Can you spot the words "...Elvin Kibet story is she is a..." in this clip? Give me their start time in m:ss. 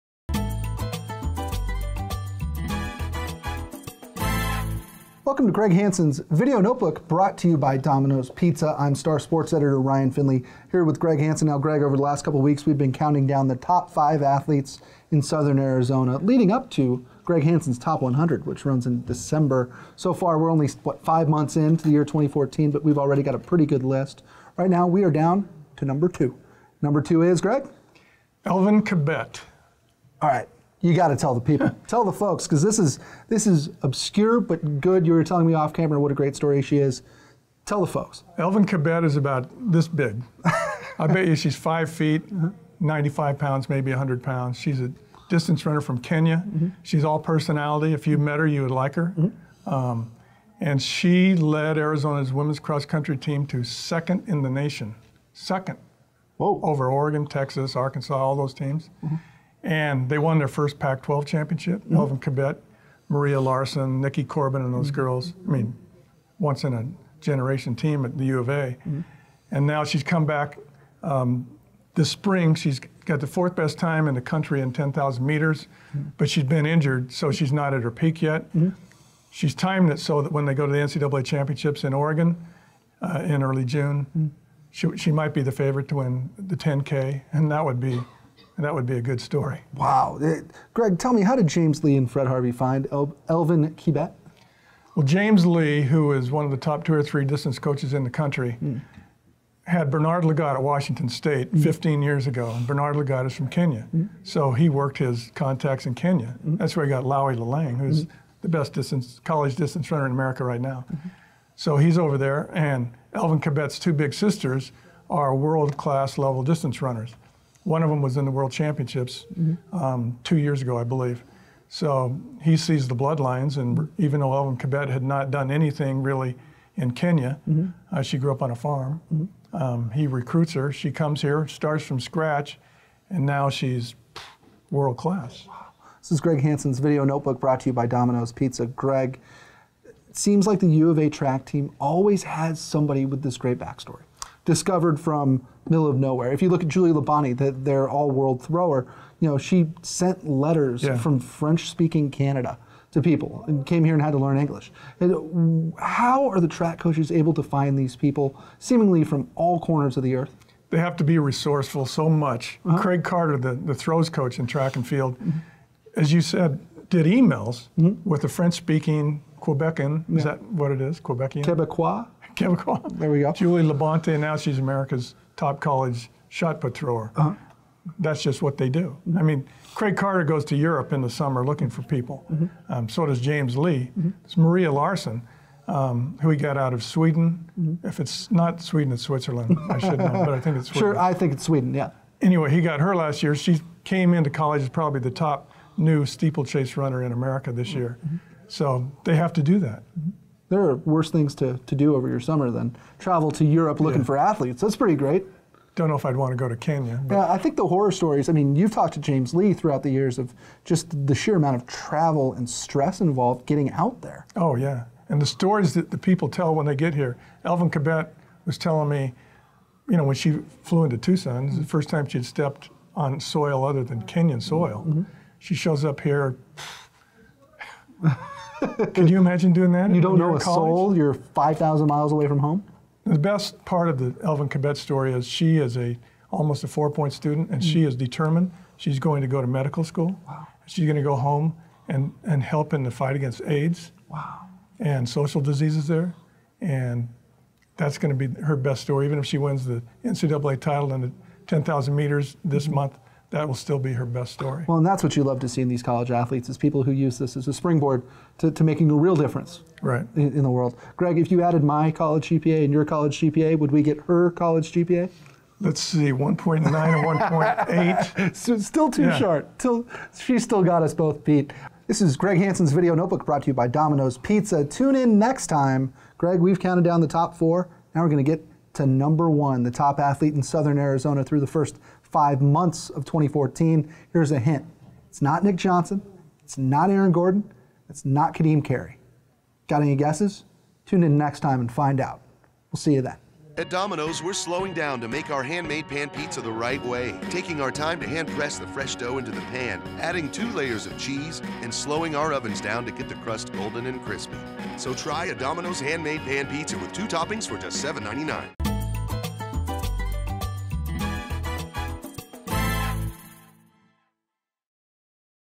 3:54.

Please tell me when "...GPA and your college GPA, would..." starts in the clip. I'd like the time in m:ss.
4:22.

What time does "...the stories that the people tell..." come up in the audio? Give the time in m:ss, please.
3:35.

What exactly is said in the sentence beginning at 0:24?
Right now, we are down to number two.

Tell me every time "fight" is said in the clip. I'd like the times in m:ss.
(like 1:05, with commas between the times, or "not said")
4:02.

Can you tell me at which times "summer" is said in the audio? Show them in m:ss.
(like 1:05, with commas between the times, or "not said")
3:01, 3:22.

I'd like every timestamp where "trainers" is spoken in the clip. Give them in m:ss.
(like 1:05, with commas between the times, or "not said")
not said.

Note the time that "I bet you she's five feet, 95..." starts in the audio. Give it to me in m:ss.
0:40.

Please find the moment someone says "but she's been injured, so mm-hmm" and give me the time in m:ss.
1:16.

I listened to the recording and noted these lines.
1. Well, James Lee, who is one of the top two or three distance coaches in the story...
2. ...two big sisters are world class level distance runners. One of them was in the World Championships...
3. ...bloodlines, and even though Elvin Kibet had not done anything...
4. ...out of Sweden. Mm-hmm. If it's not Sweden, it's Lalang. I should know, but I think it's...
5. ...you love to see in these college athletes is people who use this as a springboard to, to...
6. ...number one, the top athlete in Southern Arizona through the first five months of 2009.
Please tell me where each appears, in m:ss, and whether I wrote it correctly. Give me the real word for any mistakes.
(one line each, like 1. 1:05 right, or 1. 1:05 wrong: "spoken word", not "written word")
1. 1:34 wrong: "country", not "story"
2. 1:53 right
3. 2:02 right
4. 3:06 wrong: "Switzerland", not "Lalang"
5. 4:15 right
6. 4:38 wrong: "2014", not "2009".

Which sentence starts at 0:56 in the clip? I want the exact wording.
over Oregon, Texas, Arkansas, all those teams.